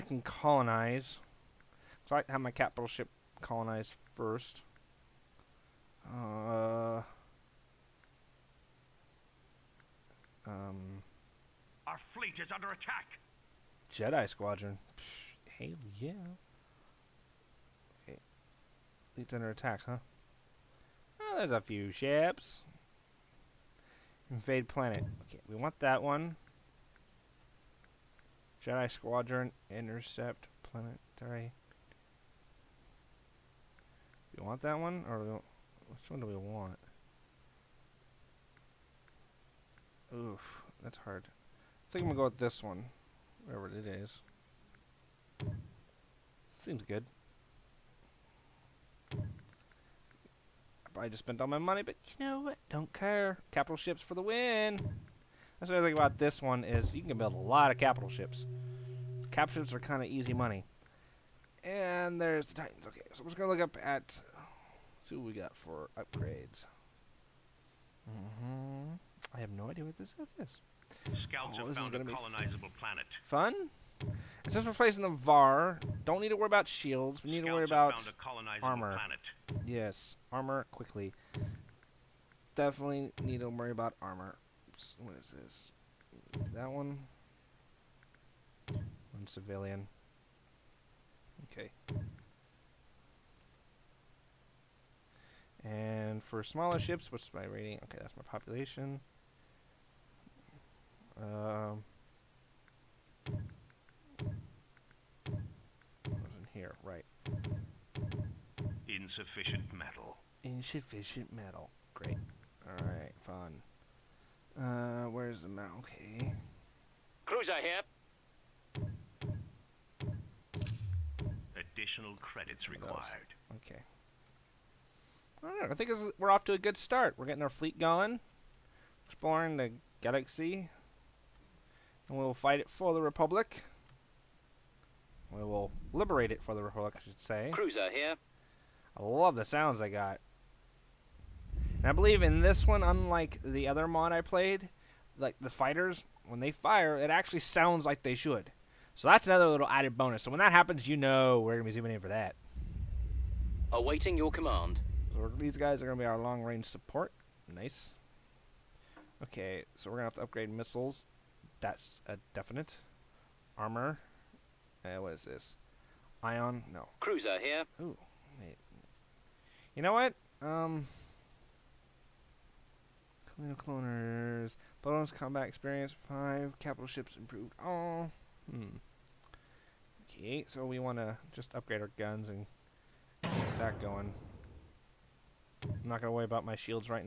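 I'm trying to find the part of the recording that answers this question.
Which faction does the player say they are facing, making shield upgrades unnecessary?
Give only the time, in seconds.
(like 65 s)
75 s.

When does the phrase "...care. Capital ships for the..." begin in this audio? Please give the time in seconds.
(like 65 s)
52 s.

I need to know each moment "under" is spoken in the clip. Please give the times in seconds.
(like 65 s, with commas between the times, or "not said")
12 s, 19 s.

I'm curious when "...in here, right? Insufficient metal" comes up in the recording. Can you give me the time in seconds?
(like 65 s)
106 s.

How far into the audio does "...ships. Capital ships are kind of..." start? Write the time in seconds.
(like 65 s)
58 s.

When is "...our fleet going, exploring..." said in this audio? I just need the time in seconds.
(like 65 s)
127 s.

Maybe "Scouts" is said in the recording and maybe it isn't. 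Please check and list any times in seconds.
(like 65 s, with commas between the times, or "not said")
71 s, 77 s.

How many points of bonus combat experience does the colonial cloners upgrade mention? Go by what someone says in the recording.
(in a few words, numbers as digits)
5.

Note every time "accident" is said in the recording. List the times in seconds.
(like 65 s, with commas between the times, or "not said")
not said.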